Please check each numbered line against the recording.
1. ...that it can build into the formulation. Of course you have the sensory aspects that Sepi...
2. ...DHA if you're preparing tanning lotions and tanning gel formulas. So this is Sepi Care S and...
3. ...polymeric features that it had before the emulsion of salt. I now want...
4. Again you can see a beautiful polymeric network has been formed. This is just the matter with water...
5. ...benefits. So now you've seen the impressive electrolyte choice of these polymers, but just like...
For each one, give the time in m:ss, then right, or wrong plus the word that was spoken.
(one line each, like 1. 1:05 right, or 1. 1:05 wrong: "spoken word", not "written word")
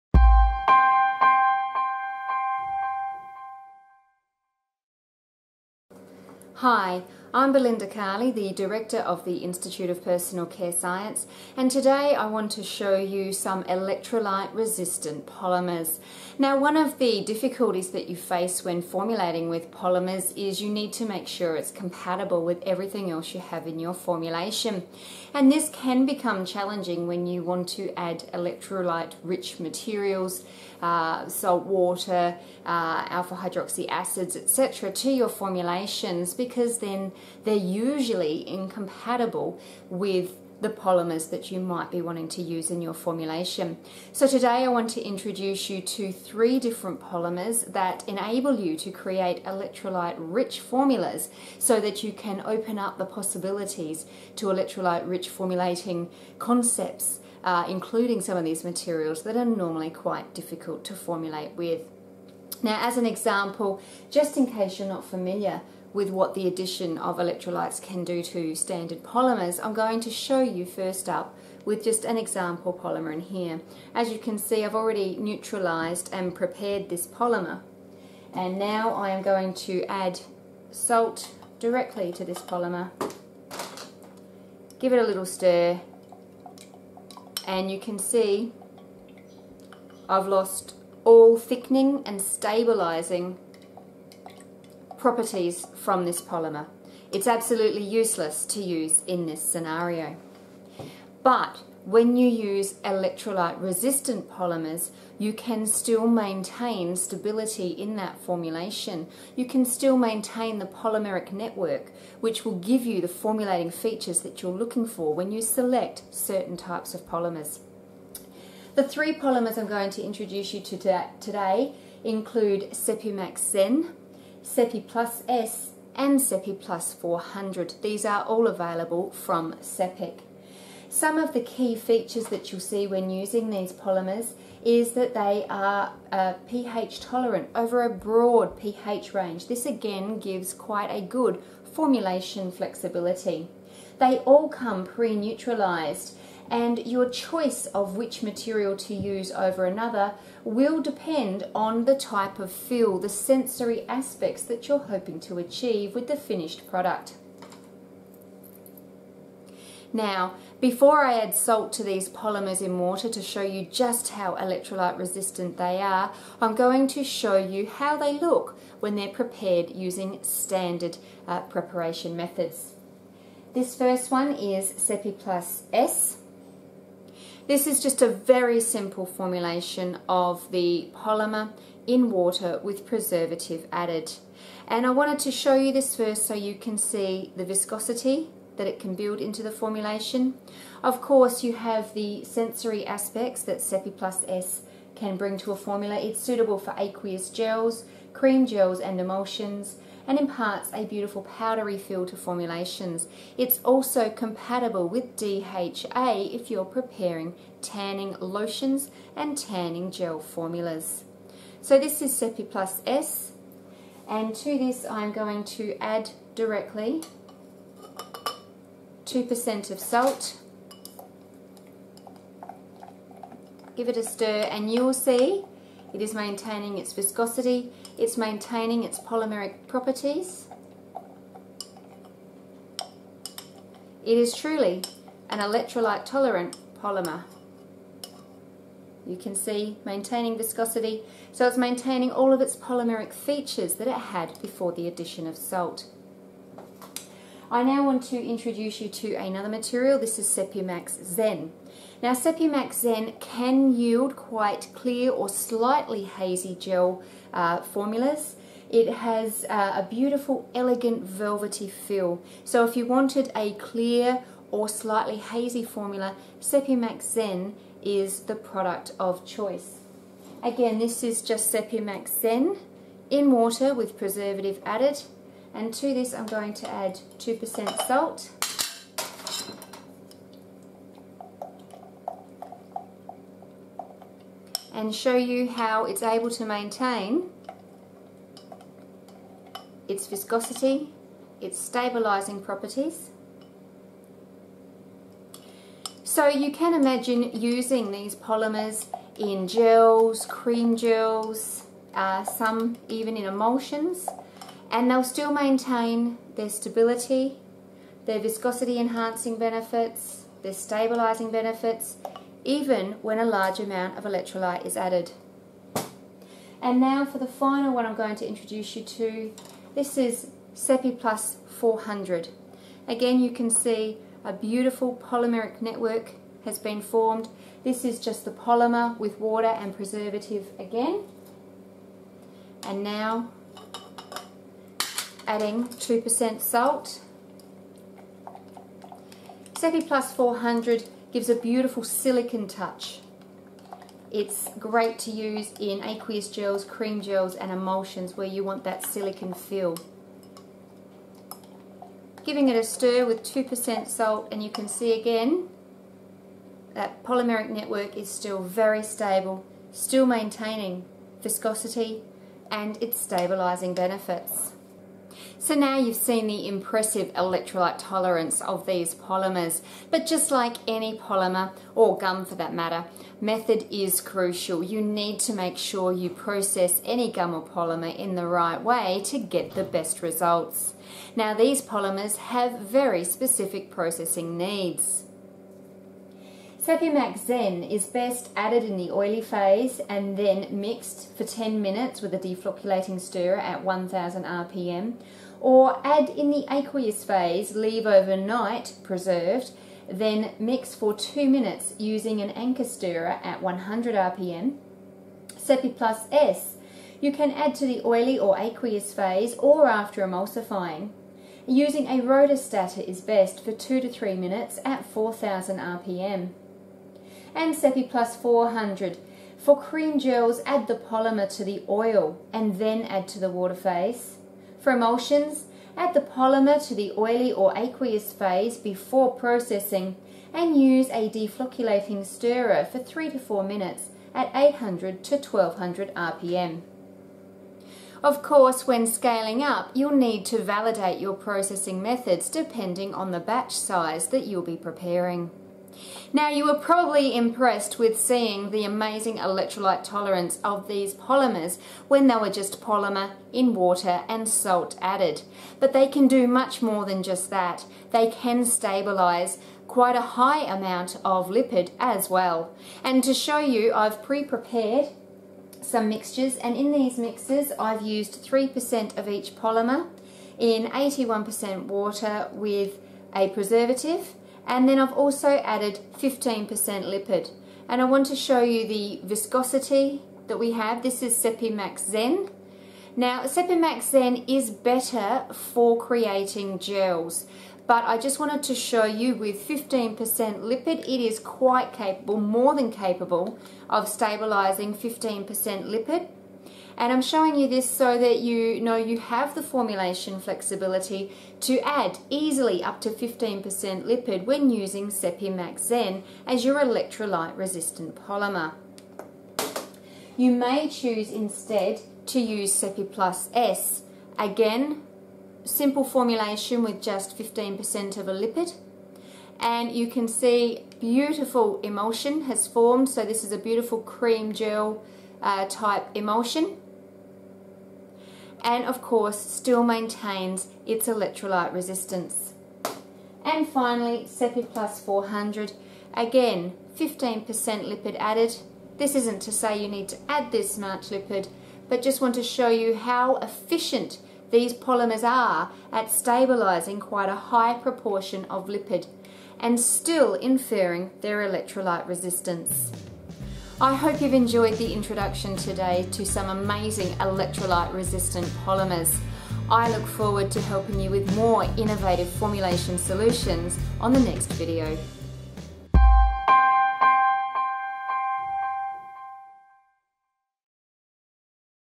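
1. 3:08 right
2. 3:25 wrong: "Plus", not "Care"
3. 4:02 wrong: "addition", not "emulsion"
4. 5:22 wrong: "polymer", not "matter"
5. 6:03 wrong: "tolerance", not "choice".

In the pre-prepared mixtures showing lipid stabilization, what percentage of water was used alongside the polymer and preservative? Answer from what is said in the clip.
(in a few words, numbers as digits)
81%.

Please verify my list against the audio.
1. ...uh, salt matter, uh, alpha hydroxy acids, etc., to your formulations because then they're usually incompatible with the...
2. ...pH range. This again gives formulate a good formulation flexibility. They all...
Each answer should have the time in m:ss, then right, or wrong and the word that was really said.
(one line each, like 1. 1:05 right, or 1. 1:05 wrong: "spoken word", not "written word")
1. 0:30 wrong: "water", not "matter"
2. 2:18 wrong: "quite", not "formulate".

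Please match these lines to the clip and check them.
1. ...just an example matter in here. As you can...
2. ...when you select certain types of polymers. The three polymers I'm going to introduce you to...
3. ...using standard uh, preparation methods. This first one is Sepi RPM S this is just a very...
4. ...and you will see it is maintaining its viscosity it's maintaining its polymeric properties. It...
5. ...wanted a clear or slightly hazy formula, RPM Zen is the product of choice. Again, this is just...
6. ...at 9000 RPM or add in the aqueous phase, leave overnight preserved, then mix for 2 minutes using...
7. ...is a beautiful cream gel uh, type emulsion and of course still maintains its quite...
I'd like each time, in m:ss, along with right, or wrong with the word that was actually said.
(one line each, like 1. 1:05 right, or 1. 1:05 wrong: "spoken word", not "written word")
1. 1:11 wrong: "polymer", not "matter"
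2. 1:55 right
3. 2:49 wrong: "Plus", not "RPM"
4. 3:44 right
5. 4:22 wrong: "Sepimax", not "RPM"
6. 6:33 wrong: "1000", not "9000"
7. 8:43 wrong: "electrolyte", not "quite".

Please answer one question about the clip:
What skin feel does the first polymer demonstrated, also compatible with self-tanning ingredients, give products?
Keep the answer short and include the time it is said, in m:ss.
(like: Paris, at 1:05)
powdery feel, at 3:21.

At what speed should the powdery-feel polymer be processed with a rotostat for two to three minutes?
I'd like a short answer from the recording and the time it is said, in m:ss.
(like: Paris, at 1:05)
4000 RPM, at 6:54.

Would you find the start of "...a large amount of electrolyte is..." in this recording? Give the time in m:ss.
5:13.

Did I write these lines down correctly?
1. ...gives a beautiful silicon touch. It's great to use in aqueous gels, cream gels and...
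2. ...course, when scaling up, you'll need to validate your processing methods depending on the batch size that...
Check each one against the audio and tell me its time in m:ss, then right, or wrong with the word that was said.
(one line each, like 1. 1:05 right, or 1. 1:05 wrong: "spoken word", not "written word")
1. 5:41 right
2. 7:18 right.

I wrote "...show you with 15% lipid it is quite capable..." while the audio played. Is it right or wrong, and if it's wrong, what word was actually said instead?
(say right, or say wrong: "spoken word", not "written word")
right.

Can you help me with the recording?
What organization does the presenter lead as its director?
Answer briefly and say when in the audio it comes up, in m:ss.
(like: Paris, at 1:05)
Institute of Personal Care Science, at 0:09.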